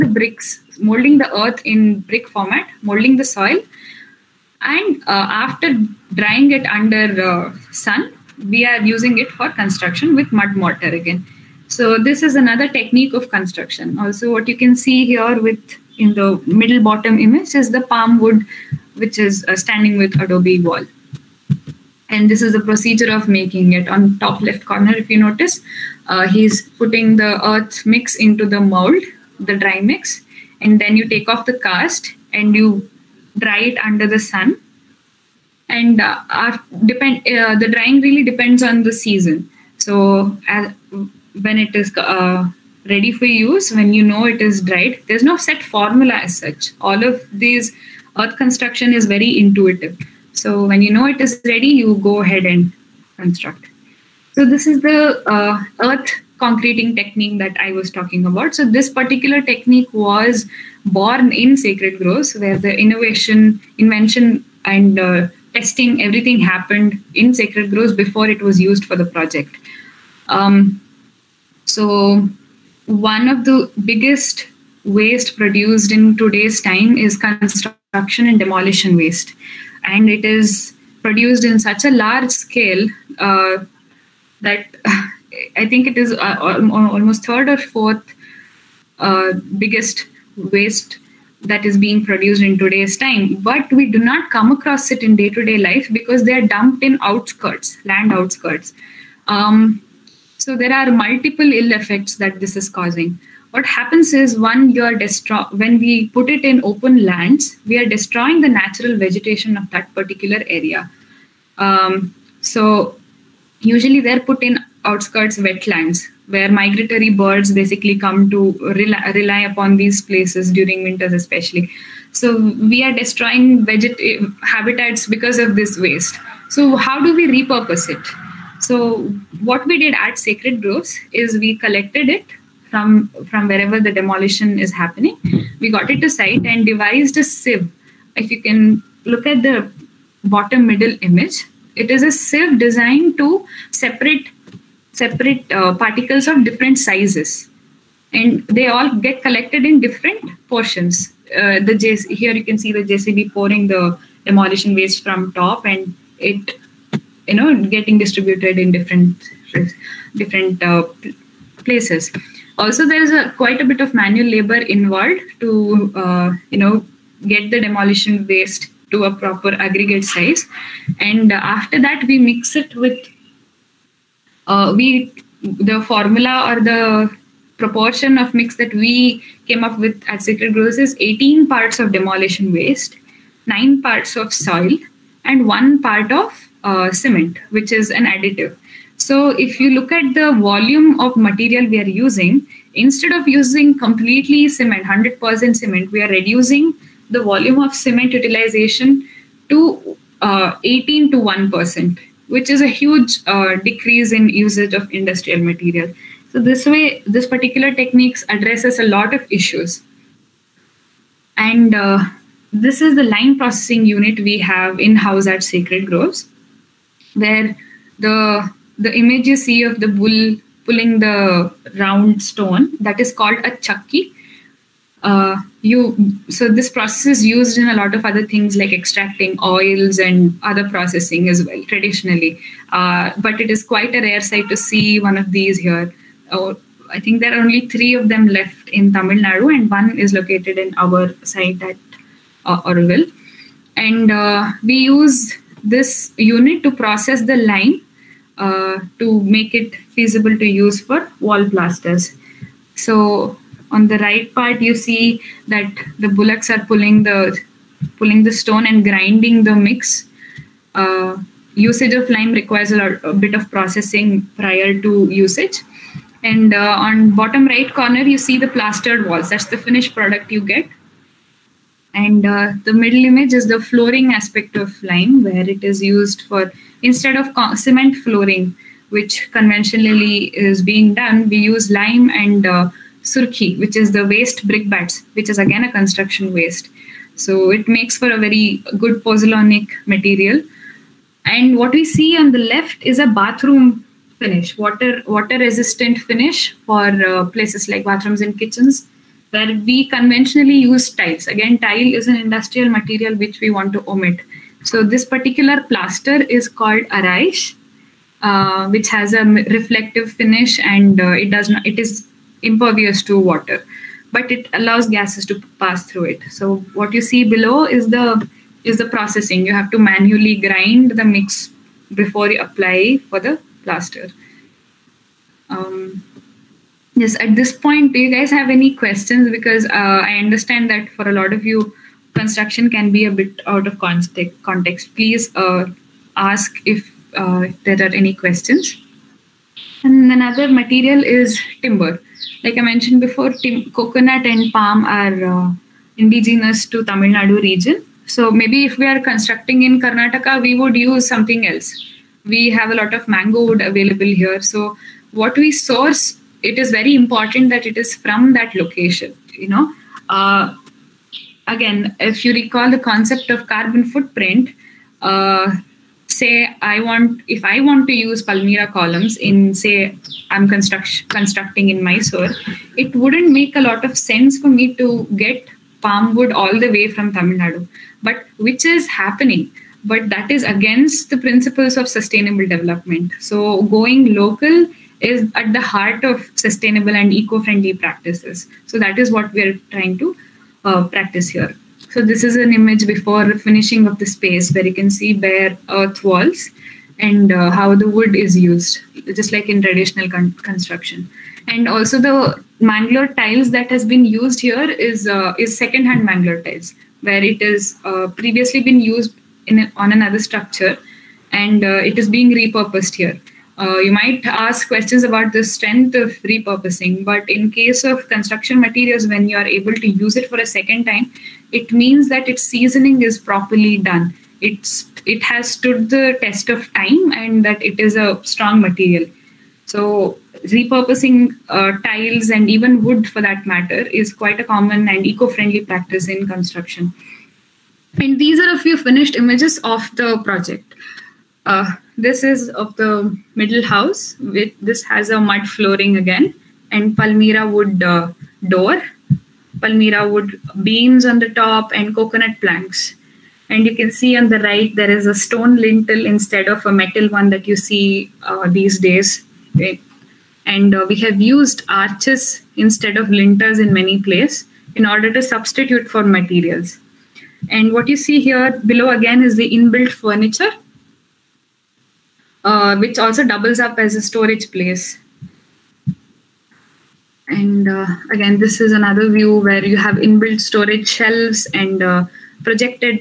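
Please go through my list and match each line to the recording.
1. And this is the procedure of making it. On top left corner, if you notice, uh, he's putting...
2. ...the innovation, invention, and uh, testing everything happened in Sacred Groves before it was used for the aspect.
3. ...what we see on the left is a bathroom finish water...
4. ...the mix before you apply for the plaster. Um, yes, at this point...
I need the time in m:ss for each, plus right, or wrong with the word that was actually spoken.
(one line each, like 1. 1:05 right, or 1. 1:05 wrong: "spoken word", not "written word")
1. 0:22 right
2. 1:02 wrong: "project", not "aspect"
3. 4:51 right
4. 5:20 right.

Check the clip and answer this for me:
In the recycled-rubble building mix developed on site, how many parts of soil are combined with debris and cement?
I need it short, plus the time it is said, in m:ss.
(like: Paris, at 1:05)
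9, at 3:03.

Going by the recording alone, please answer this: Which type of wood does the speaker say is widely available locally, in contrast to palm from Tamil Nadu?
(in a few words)
mango wood.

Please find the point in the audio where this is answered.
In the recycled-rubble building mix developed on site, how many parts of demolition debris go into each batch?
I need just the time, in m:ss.
3:00.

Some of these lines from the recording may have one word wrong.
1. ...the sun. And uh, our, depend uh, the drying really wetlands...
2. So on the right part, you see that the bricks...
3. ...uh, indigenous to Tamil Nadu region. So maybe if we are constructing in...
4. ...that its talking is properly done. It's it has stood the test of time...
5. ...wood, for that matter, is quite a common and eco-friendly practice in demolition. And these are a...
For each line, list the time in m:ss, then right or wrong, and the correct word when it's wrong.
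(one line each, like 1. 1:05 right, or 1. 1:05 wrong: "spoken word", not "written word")
1. 0:34 wrong: "depends", not "wetlands"
2. 4:12 wrong: "bullocks", not "bricks"
3. 5:45 right
4. 7:02 wrong: "seasoning", not "talking"
5. 7:12 wrong: "construction", not "demolition".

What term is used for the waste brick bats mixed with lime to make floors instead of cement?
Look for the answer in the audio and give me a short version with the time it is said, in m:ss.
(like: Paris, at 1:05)
surki, at 4:43.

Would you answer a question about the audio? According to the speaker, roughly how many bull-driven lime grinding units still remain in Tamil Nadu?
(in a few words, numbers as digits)
3.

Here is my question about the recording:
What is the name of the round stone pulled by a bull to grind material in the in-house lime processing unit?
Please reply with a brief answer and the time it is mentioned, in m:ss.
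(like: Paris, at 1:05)
chakki, at 3:43.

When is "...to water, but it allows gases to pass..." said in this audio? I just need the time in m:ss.
5:13.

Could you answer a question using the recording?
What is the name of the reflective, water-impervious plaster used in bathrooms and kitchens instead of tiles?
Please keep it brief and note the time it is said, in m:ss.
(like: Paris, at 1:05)
Araish, at 5:06.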